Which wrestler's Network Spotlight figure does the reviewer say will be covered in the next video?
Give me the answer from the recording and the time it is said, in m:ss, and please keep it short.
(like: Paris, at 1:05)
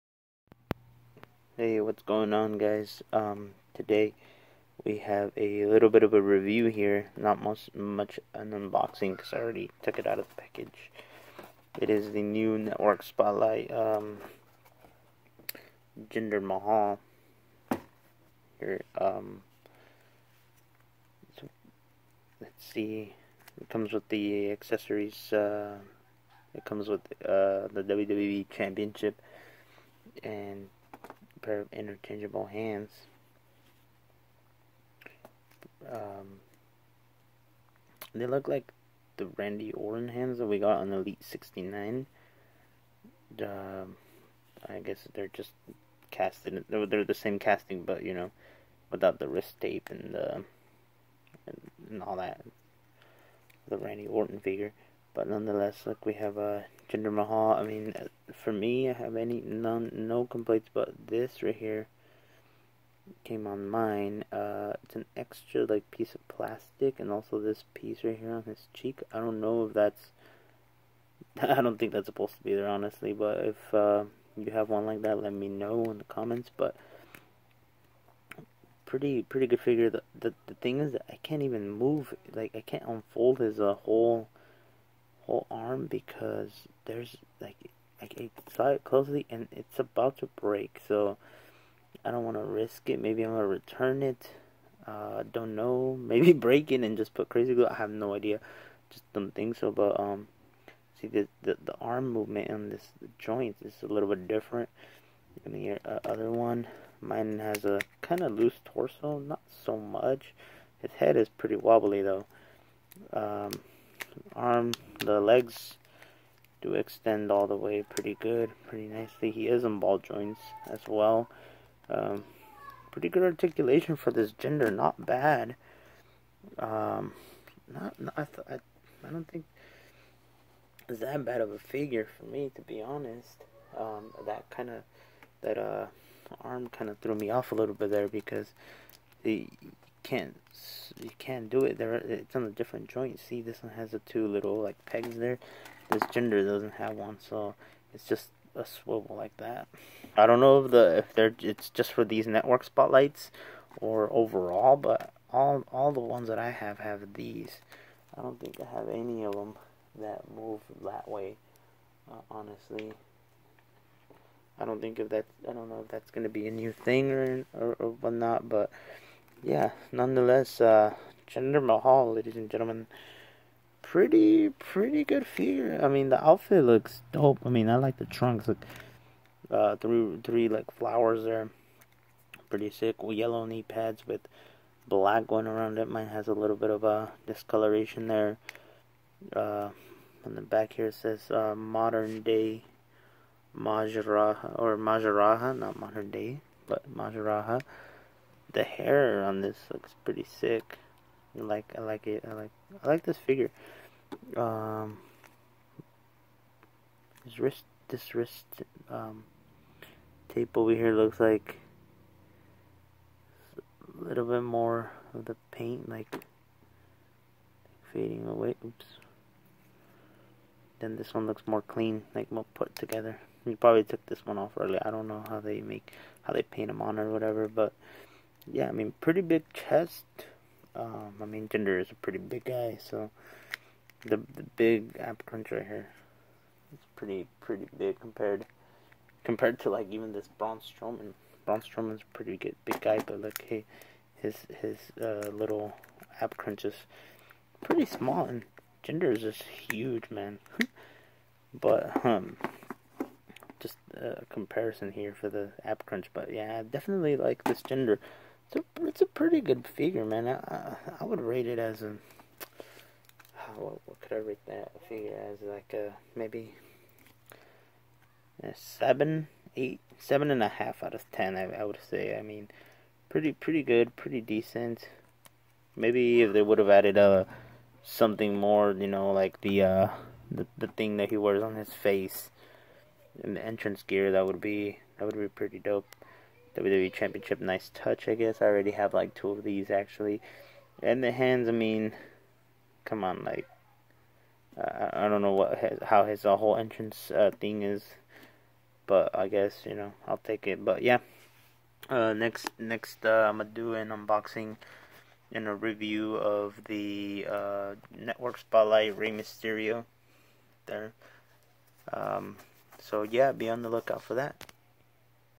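Rey Mysterio, at 5:08.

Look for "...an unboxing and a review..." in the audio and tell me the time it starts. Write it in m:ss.
5:03.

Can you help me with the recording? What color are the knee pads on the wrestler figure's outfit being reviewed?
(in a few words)
Yellow.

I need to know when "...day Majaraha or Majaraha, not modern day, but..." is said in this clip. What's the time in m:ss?
3:12.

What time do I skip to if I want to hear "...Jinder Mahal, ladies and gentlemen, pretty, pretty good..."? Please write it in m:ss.
2:51.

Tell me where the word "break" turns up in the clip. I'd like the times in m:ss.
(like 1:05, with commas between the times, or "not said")
1:30, 1:36.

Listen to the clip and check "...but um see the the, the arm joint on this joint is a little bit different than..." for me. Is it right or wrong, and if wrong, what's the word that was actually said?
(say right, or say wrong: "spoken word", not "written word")
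wrong: "movement", not "joint".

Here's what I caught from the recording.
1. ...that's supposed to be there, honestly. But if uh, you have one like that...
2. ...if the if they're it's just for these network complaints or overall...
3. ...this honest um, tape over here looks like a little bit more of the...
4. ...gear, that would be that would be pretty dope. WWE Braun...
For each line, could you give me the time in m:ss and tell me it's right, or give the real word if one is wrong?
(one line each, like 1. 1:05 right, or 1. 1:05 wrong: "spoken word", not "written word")
1. 1:11 right
2. 2:30 wrong: "spotlights", not "complaints"
3. 3:27 wrong: "wrist", not "honest"
4. 4:43 wrong: "Championship", not "Braun".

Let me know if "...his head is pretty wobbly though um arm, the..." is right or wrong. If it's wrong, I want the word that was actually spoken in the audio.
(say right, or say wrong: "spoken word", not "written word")
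right.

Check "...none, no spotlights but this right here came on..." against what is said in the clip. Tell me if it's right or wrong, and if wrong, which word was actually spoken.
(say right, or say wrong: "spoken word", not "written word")
wrong: "complaints", not "spotlights".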